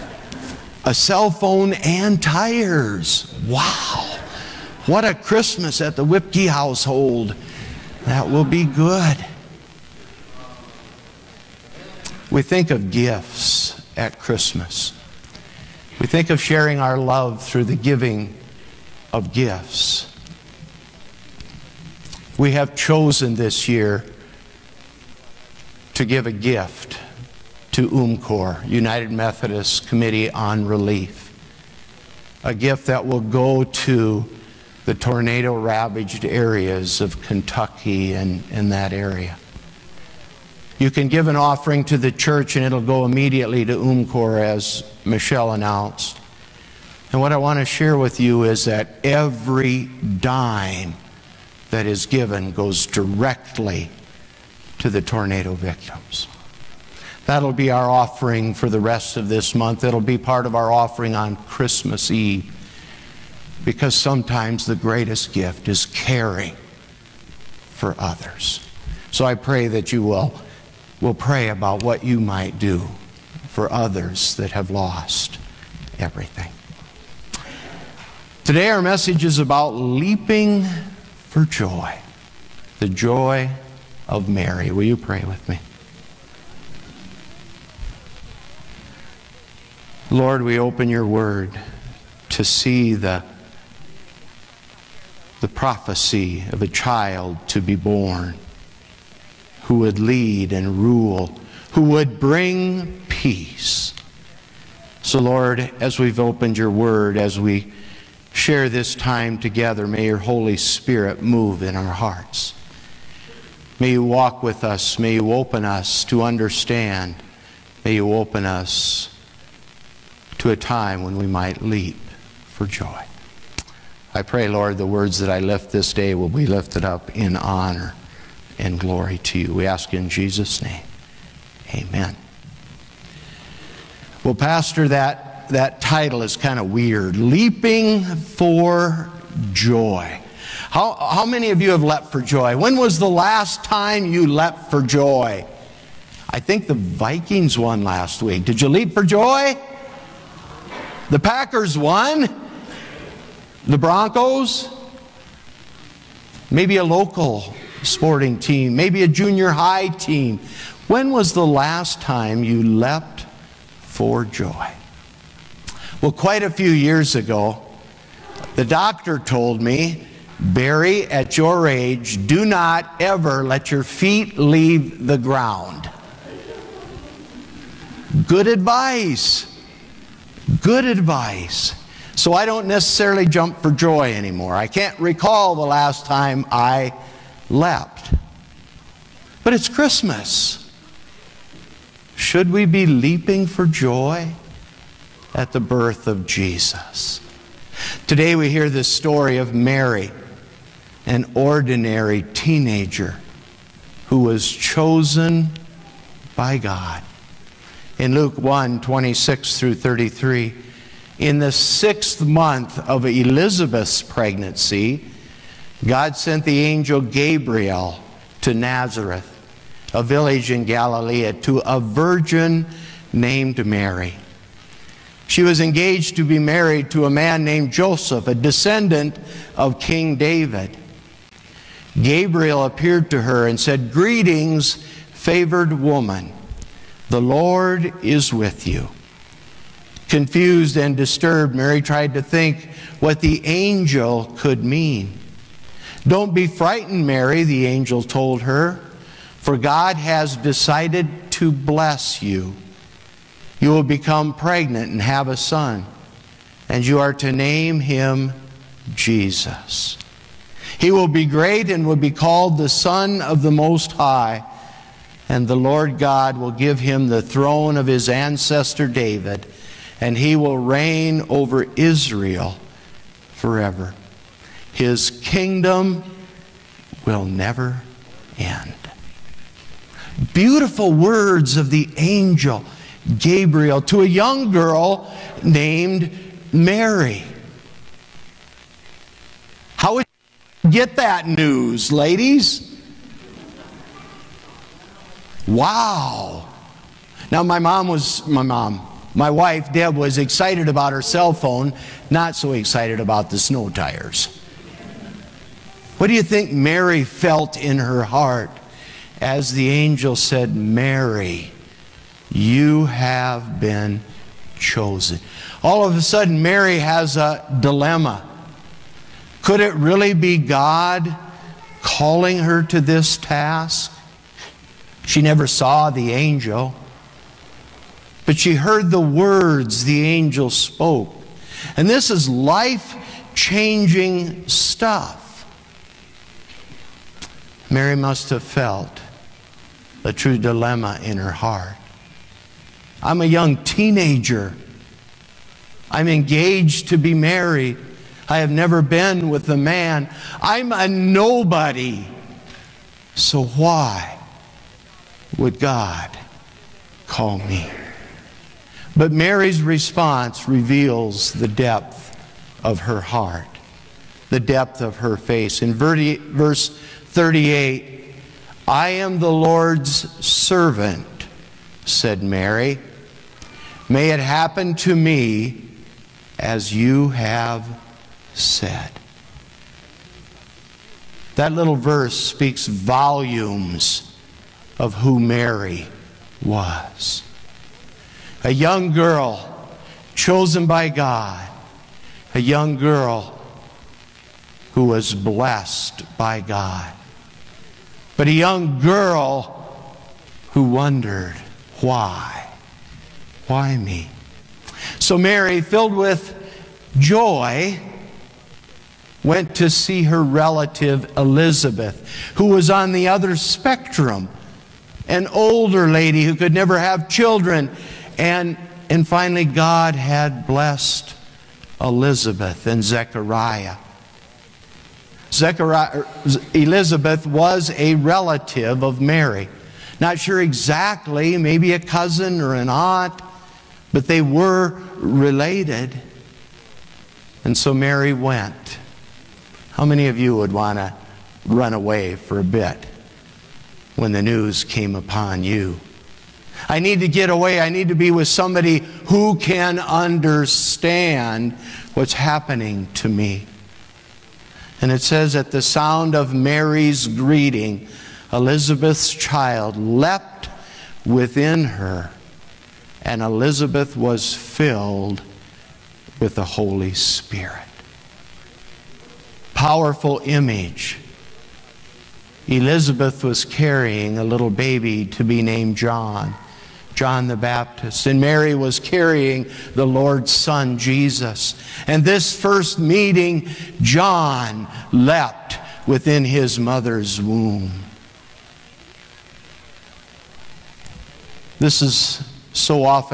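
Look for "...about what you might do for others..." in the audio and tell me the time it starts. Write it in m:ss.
1:11.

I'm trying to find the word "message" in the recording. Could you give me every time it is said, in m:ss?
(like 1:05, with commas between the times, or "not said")
1:18.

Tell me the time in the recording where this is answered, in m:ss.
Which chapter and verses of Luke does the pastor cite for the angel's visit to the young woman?
3:28.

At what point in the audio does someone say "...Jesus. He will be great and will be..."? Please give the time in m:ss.
4:18.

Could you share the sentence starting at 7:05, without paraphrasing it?
Zechariah, er, Elizabeth was a relative of Mary.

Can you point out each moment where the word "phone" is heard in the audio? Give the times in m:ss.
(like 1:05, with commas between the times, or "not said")
0:01, 5:01.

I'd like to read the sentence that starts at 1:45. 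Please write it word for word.
So, Lord, as we've opened your word, as we share this time together, may your Holy Spirit move in our hearts.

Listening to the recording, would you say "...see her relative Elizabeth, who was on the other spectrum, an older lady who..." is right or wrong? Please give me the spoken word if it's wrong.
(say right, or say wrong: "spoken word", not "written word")
right.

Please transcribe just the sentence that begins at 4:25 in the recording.
And the Lord God will give him the throne of his ancestor David, and he will reign over Israel forever.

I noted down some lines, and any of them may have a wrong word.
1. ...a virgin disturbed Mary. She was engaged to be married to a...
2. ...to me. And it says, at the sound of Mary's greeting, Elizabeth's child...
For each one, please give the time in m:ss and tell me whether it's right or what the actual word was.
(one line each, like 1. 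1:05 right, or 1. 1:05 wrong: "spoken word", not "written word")
1. 3:41 wrong: "named", not "disturbed"
2. 7:32 right.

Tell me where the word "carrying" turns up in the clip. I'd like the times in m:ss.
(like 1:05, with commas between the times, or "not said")
7:53, 7:58.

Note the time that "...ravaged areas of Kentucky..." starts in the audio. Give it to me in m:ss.
0:35.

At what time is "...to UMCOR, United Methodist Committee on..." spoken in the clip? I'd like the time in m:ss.
0:27.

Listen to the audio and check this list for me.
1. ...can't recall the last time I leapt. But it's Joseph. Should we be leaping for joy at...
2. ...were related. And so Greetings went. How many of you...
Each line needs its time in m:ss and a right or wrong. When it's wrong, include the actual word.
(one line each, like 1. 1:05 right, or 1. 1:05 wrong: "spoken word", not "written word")
1. 3:04 wrong: "Christmas", not "Joseph"
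2. 7:14 wrong: "Mary", not "Greetings".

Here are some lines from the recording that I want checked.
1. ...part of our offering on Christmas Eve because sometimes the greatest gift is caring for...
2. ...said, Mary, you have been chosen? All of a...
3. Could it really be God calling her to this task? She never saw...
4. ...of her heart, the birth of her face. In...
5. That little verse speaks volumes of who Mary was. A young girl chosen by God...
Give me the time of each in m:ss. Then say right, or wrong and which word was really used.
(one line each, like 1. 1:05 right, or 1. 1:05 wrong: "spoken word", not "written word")
1. 1:00 right
2. 5:10 right
3. 5:19 right
4. 6:02 wrong: "depth", not "birth"
5. 6:21 right.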